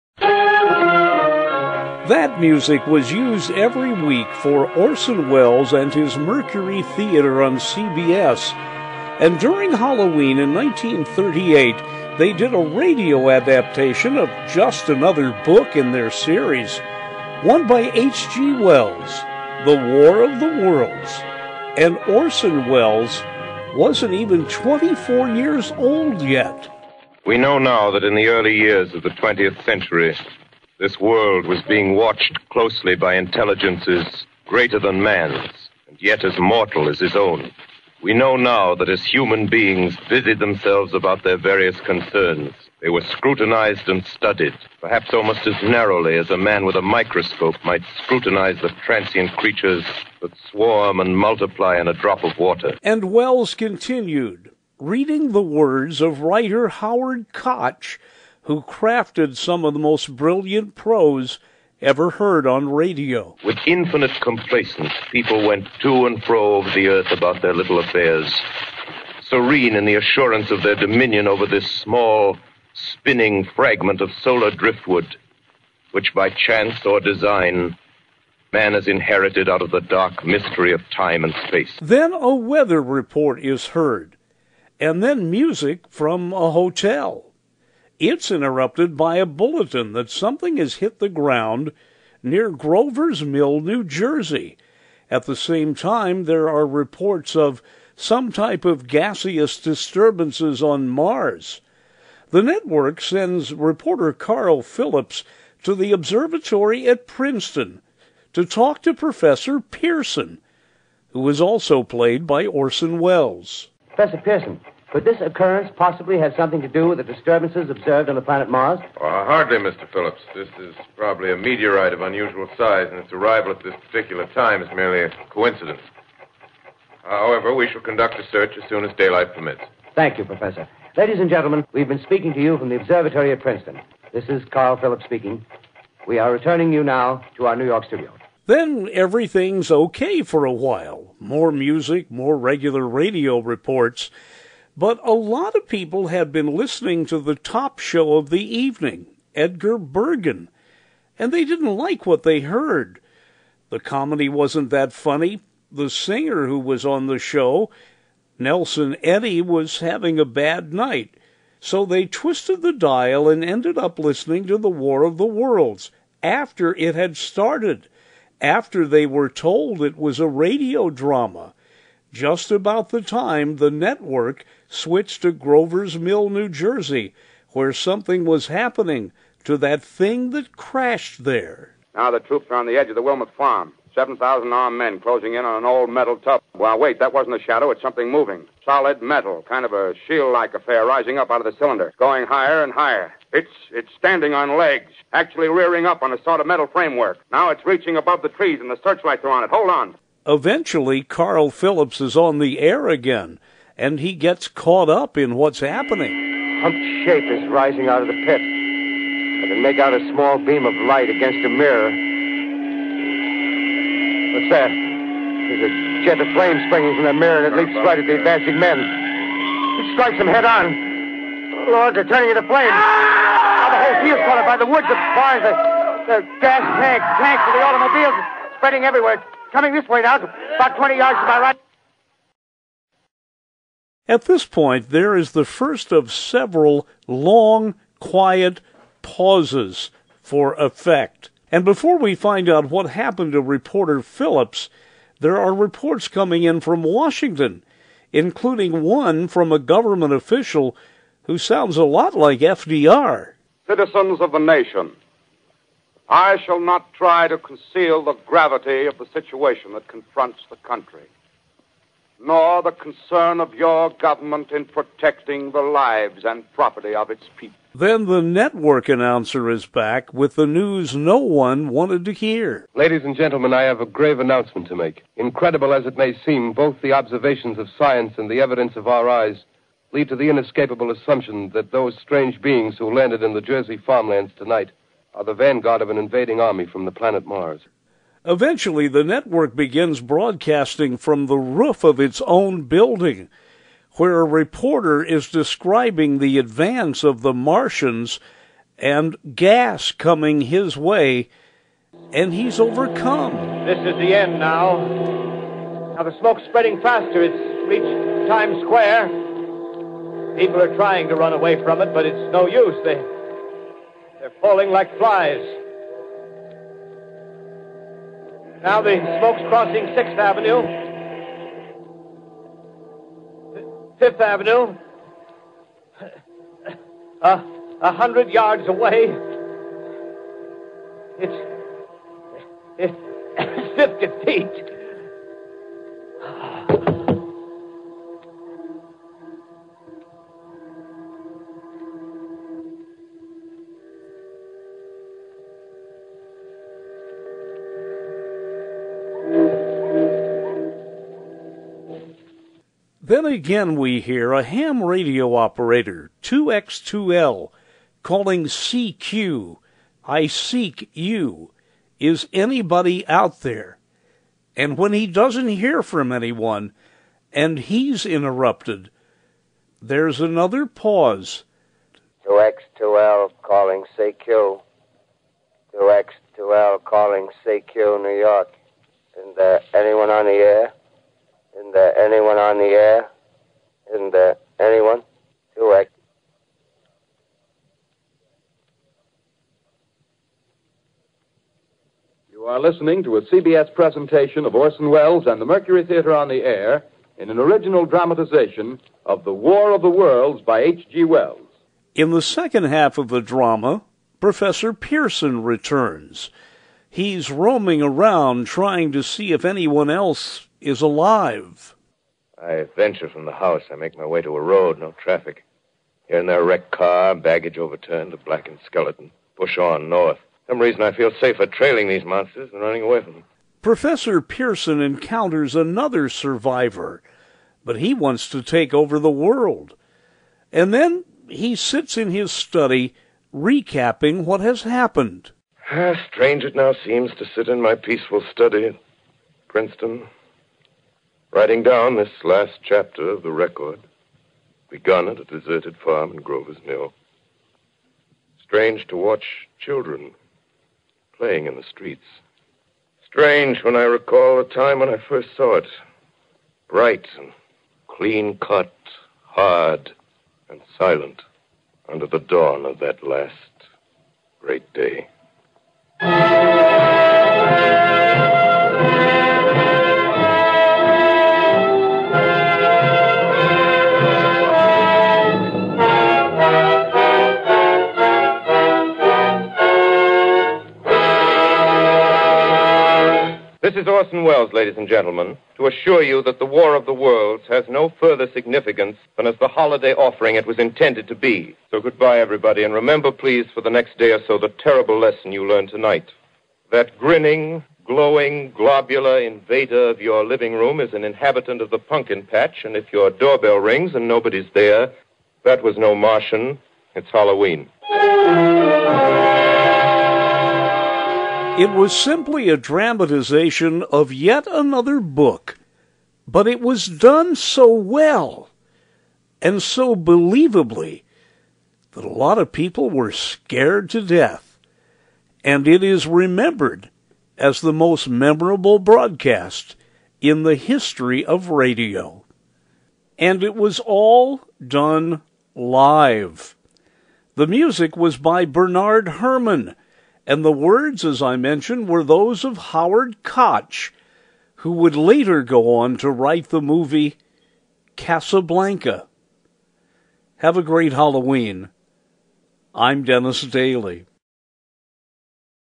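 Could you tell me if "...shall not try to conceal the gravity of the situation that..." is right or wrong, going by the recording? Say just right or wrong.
right.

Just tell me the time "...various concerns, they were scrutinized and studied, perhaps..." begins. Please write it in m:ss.
0:41.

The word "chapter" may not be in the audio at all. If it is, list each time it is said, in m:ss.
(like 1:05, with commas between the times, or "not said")
7:22.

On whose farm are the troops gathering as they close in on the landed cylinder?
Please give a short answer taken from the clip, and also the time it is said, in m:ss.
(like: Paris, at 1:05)
Wilmot farm, at 3:03.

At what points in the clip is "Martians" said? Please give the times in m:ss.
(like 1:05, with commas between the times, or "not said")
4:57, 8:25.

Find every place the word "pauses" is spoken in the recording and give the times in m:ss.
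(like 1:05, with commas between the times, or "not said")
3:59, 6:10.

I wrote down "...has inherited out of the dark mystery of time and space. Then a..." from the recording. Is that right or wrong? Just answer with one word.
right.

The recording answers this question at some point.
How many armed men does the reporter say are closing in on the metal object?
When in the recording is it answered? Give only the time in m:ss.
3:03.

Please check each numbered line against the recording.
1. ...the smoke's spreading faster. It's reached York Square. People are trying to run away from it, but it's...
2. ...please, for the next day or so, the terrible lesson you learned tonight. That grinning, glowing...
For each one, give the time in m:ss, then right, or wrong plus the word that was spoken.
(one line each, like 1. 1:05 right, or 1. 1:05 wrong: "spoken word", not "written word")
1. 5:06 wrong: "Times", not "York"
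2. 8:13 right.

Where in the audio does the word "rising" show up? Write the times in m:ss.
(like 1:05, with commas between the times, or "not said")
3:10, 3:27.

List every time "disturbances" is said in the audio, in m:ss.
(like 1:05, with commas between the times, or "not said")
1:39, 1:57.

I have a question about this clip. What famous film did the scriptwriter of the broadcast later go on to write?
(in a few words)
Casablanca.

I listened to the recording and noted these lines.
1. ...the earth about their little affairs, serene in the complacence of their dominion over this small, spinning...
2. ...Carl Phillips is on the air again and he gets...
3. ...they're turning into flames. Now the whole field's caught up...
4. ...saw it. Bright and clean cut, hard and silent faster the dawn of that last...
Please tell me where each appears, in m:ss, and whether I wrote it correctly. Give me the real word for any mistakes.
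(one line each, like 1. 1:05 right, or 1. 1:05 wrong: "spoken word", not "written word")
1. 1:06 wrong: "assurance", not "complacence"
2. 3:21 right
3. 3:41 right
4. 7:35 wrong: "under", not "faster".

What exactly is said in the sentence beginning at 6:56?
Here and there, wrecked car, baggage overturned, a blackened skeleton.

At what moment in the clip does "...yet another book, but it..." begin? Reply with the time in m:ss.
8:34.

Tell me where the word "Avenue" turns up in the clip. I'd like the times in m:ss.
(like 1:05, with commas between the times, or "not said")
5:20, 5:24.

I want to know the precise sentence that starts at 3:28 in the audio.
I can make out a small beam of light against a mirror.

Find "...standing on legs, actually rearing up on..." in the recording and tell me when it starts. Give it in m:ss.
3:13.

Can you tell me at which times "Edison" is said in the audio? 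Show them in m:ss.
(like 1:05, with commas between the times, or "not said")
not said.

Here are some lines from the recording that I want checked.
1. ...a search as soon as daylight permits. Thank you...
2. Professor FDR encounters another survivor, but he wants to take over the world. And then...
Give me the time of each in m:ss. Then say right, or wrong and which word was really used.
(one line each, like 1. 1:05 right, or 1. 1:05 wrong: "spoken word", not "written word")
1. 2:08 right
2. 7:03 wrong: "Pearson", not "FDR".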